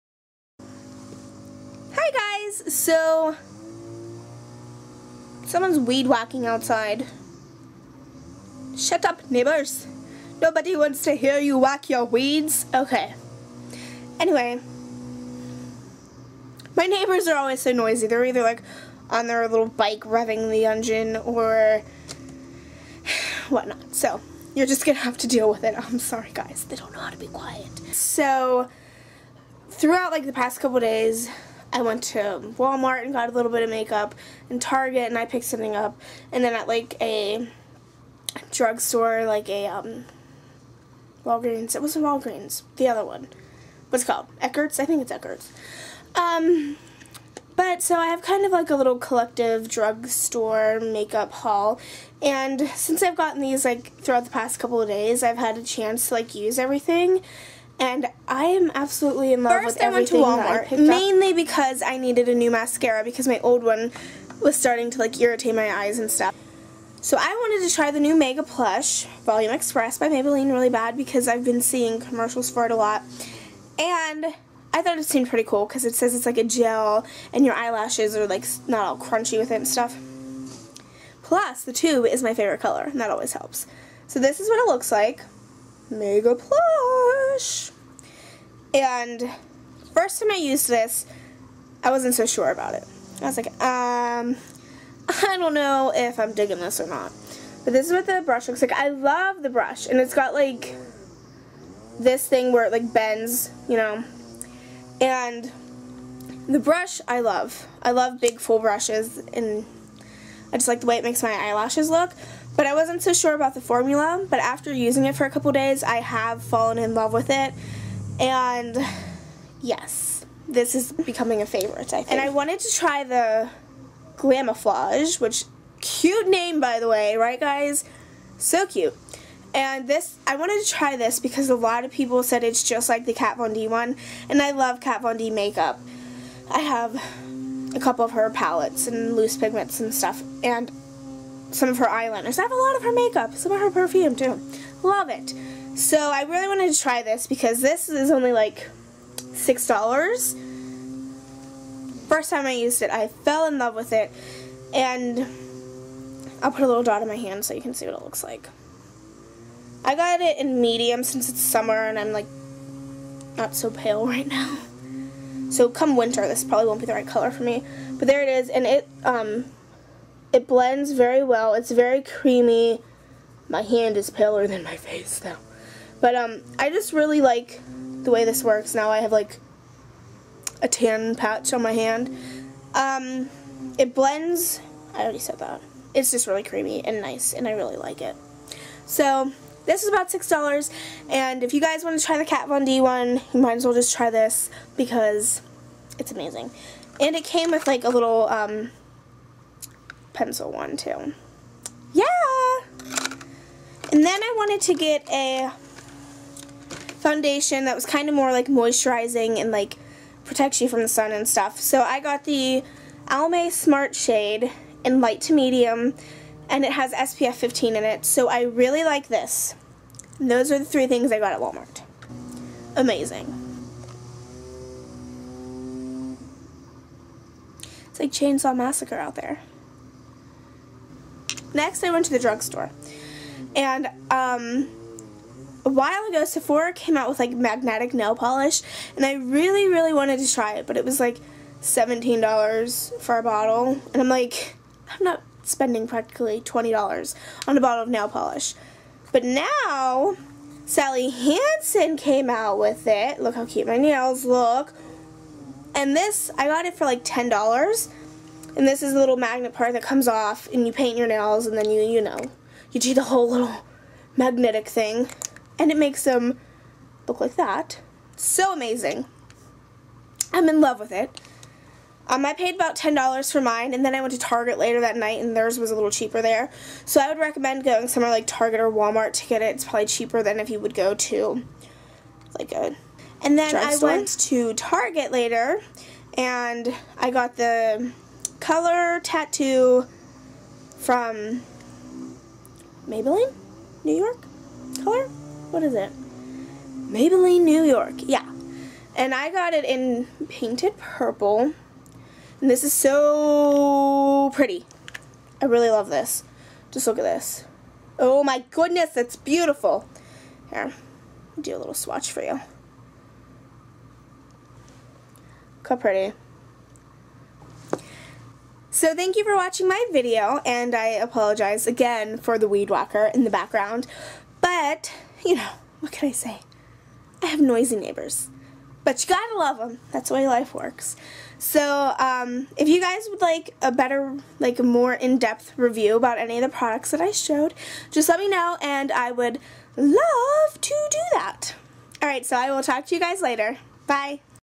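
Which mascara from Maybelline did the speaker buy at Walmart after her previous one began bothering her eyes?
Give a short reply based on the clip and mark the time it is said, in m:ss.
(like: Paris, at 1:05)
Mega Plush Volume Express, at 1:08.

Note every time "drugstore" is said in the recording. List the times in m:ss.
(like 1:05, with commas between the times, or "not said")
0:38, 0:49, 3:52.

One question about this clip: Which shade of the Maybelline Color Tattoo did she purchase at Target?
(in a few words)
Painted Purple.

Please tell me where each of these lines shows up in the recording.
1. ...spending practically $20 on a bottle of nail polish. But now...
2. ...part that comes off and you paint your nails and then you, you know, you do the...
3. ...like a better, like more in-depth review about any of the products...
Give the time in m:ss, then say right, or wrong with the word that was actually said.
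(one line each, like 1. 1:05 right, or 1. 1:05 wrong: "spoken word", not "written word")
1. 4:05 right
2. 4:19 right
3. 5:33 right.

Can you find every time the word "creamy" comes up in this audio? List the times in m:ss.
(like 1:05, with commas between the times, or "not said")
2:52, 3:06.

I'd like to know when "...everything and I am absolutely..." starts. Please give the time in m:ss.
0:56.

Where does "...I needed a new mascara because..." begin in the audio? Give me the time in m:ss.
1:01.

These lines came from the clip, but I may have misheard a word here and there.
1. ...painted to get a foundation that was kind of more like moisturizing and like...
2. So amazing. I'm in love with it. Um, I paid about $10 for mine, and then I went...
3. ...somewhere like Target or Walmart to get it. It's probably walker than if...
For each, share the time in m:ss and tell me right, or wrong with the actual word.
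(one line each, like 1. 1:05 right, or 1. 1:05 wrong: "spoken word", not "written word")
1. 3:24 wrong: "wanted", not "painted"
2. 4:28 right
3. 4:37 wrong: "cheaper", not "walker".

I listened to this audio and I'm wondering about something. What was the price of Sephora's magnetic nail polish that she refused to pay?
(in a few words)
$17.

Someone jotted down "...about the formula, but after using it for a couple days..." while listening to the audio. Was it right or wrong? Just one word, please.
right.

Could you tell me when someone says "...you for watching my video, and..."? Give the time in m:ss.
5:19.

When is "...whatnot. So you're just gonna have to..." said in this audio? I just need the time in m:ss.
0:23.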